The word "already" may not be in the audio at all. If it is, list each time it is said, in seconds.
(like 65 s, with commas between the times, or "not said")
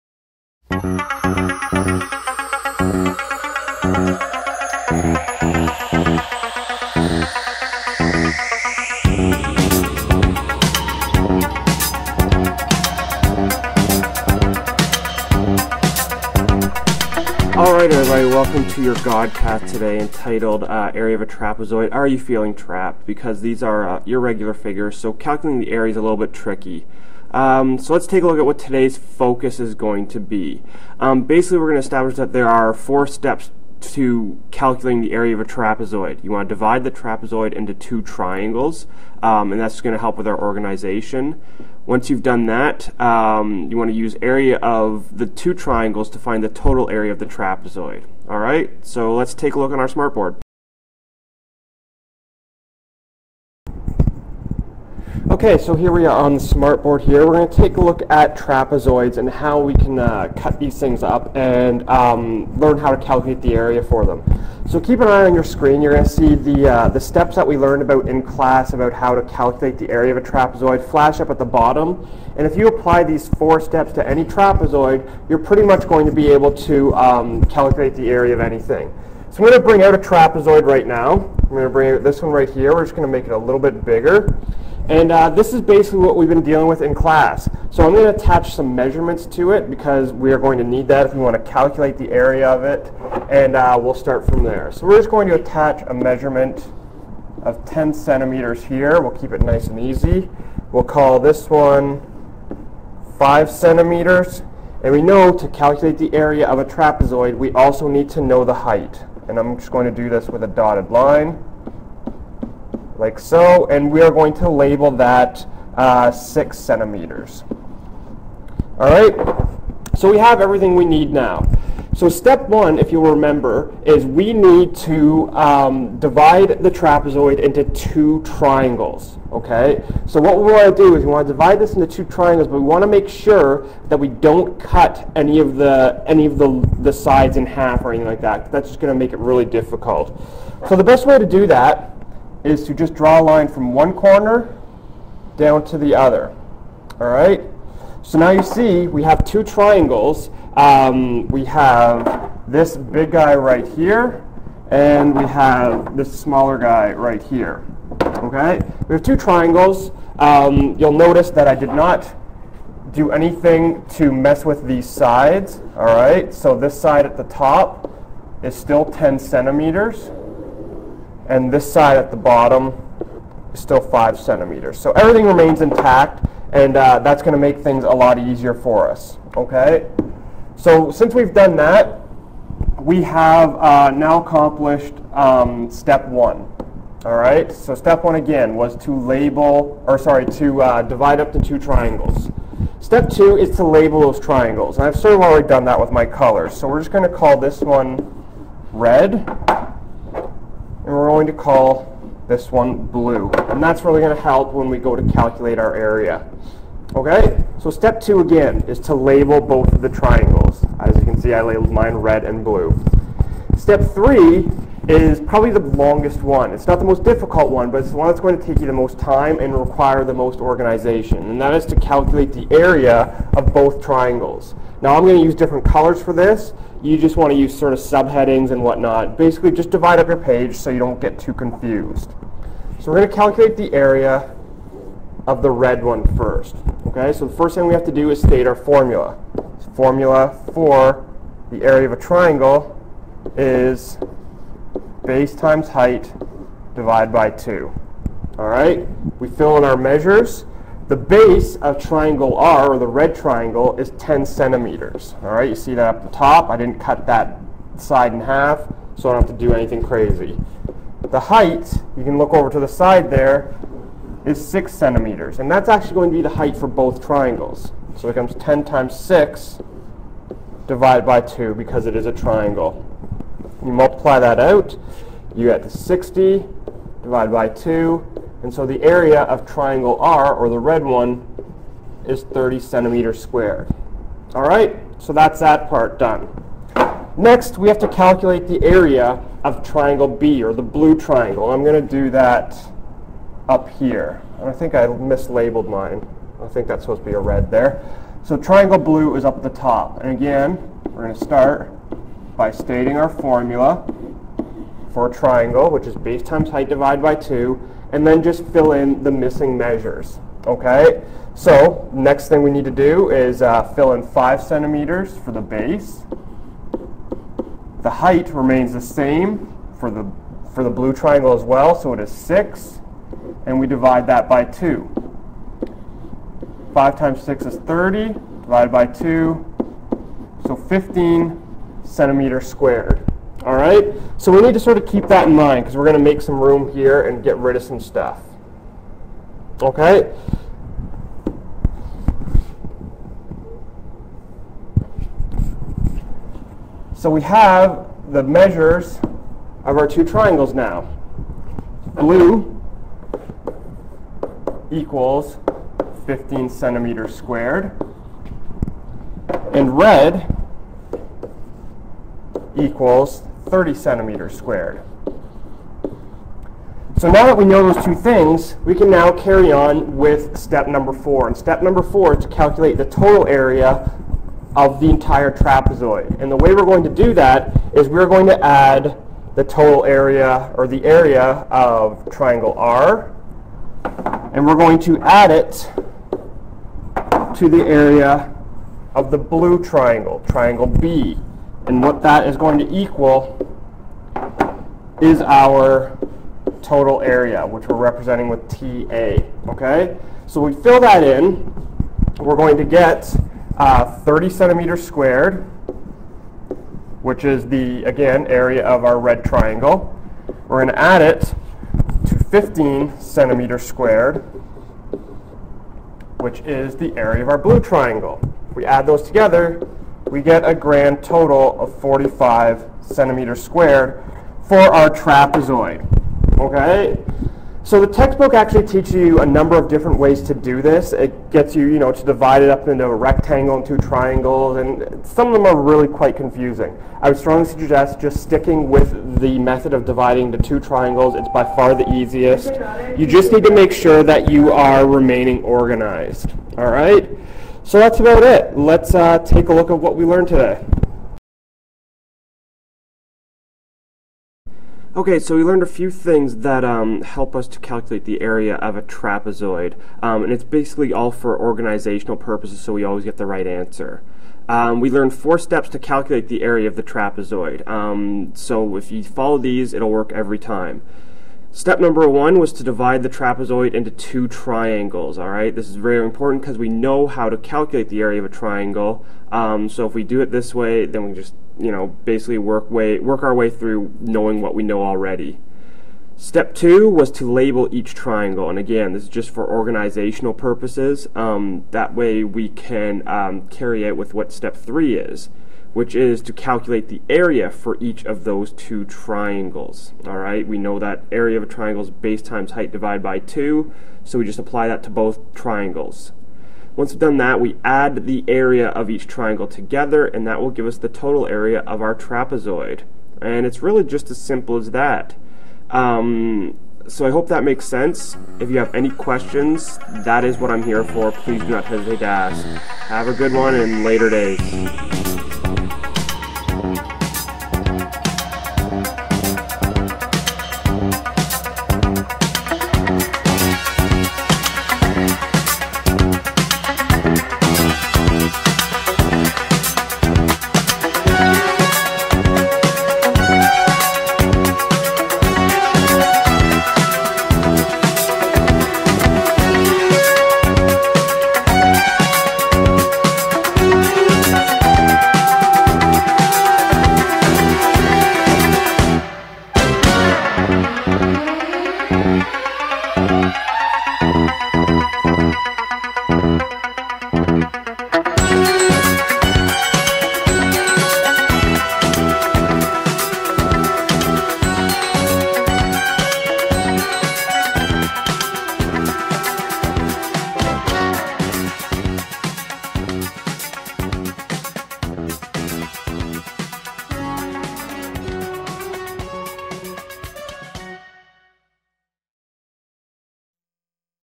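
195 s, 484 s.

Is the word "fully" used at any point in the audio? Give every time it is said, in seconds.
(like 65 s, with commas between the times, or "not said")
not said.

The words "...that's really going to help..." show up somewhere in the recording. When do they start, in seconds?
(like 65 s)
203 s.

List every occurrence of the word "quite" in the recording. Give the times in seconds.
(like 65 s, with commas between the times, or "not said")
435 s.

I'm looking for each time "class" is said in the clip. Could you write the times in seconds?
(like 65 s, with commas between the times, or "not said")
68 s, 86 s.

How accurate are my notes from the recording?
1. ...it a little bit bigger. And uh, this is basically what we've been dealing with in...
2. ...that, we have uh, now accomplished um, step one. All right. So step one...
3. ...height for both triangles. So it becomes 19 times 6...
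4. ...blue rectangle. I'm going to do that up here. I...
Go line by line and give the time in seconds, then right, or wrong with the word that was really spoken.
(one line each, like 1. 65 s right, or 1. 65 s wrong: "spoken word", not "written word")
1. 83 s right
2. 181 s right
3. 266 s wrong: "10", not "19"
4. 290 s wrong: "triangle", not "rectangle".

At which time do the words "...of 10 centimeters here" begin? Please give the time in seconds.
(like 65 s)
97 s.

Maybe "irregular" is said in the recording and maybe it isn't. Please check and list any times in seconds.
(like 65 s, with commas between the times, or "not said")
24 s.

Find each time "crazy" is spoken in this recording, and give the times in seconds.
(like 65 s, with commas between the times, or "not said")
259 s.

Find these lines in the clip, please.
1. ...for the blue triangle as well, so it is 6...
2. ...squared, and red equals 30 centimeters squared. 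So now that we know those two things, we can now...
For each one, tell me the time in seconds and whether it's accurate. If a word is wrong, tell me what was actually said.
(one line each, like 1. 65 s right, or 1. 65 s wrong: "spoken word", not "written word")
1. 320 s right
2. 357 s right.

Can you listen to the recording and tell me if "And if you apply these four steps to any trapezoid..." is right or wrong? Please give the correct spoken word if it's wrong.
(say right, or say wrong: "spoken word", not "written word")
right.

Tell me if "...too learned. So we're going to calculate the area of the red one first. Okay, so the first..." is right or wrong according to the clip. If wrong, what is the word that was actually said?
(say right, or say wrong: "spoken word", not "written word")
wrong: "confused", not "learned".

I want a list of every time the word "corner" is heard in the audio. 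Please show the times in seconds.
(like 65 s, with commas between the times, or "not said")
143 s.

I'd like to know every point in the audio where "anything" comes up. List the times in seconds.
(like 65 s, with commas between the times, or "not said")
78 s, 137 s, 163 s, 259 s.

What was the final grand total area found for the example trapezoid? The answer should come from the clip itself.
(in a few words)
45 square centimeters.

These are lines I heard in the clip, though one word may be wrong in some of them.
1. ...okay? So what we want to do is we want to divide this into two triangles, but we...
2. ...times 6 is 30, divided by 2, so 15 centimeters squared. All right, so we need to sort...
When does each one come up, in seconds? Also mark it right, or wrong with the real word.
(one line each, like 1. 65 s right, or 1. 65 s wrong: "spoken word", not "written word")
1. 129 s right
2. 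326 s right.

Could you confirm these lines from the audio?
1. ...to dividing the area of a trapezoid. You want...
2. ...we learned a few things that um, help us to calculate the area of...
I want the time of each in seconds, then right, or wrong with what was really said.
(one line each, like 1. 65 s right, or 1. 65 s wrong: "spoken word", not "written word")
1. 33 s wrong: "calculating", not "dividing"
2. 455 s right.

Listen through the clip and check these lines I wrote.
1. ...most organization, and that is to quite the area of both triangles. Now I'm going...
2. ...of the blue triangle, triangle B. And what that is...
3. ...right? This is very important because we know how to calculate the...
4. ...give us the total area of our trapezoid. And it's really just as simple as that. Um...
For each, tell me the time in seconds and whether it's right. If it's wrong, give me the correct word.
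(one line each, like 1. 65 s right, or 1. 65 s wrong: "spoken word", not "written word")
1. 220 s wrong: "calculate", not "quite"
2. 388 s right
3. 475 s right
4. 510 s right.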